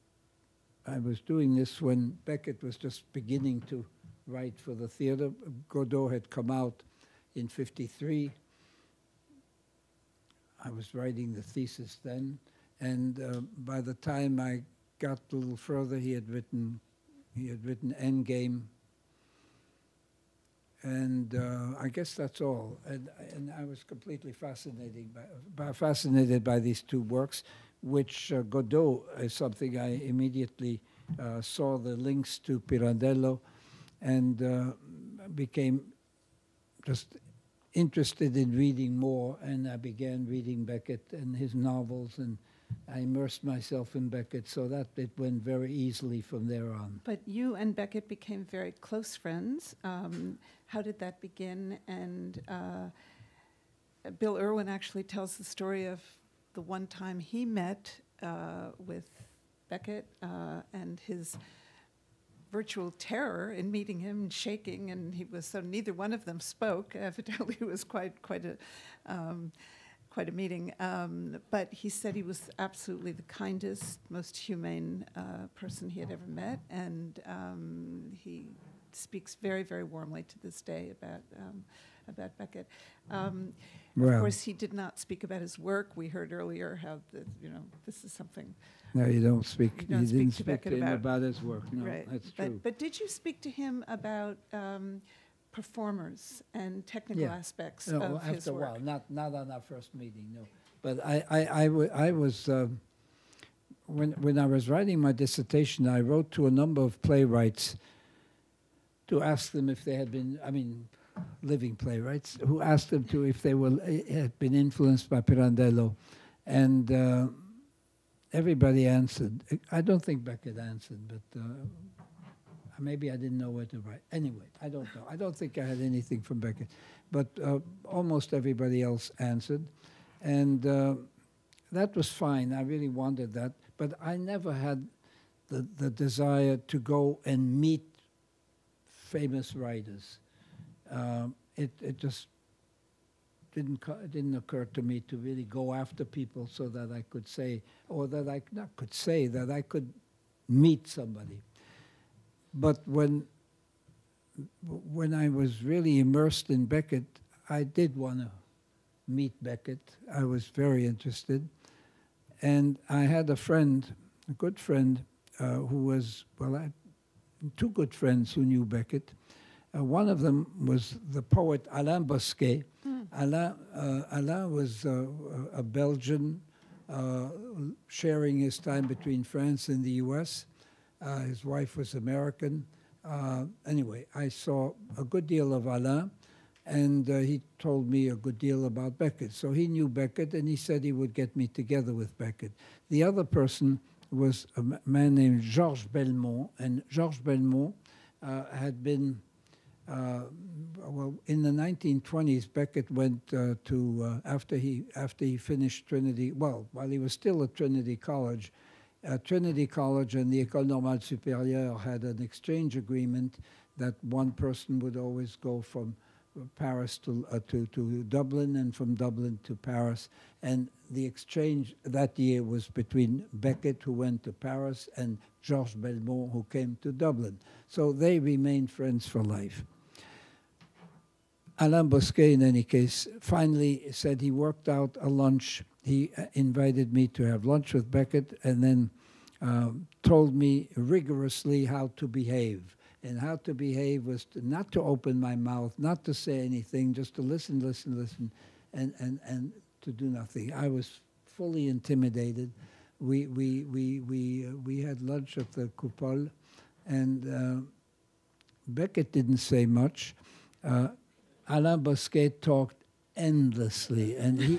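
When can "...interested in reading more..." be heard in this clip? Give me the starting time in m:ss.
0:37.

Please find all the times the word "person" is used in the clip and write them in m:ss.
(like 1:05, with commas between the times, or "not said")
1:15, 3:13, 3:34.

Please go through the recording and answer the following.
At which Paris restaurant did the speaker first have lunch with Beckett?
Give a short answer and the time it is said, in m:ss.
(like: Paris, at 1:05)
The Coupole, at 4:15.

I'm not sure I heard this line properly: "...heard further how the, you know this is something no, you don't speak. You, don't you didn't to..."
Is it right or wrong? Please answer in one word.
wrong.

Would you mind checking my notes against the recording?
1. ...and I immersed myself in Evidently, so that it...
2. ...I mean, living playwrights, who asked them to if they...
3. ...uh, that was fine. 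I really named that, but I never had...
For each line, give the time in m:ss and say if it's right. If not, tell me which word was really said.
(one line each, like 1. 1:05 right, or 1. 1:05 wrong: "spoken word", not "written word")
1. 0:42 wrong: "Beckett", not "Evidently"
2. 1:50 right
3. 2:10 wrong: "wanted", not "named".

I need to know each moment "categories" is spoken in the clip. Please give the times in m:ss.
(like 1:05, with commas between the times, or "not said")
not said.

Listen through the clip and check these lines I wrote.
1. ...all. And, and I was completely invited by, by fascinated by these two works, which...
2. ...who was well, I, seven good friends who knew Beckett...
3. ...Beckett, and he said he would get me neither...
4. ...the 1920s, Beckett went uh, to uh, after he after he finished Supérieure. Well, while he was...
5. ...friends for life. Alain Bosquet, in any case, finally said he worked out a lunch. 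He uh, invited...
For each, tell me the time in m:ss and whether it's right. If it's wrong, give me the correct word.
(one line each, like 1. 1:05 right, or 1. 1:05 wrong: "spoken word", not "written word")
1. 0:22 wrong: "fascinated", not "invited"
2. 2:45 wrong: "two", not "seven"
3. 3:09 wrong: "together", not "neither"
4. 3:21 wrong: "Trinity", not "Supérieure"
5. 3:48 right.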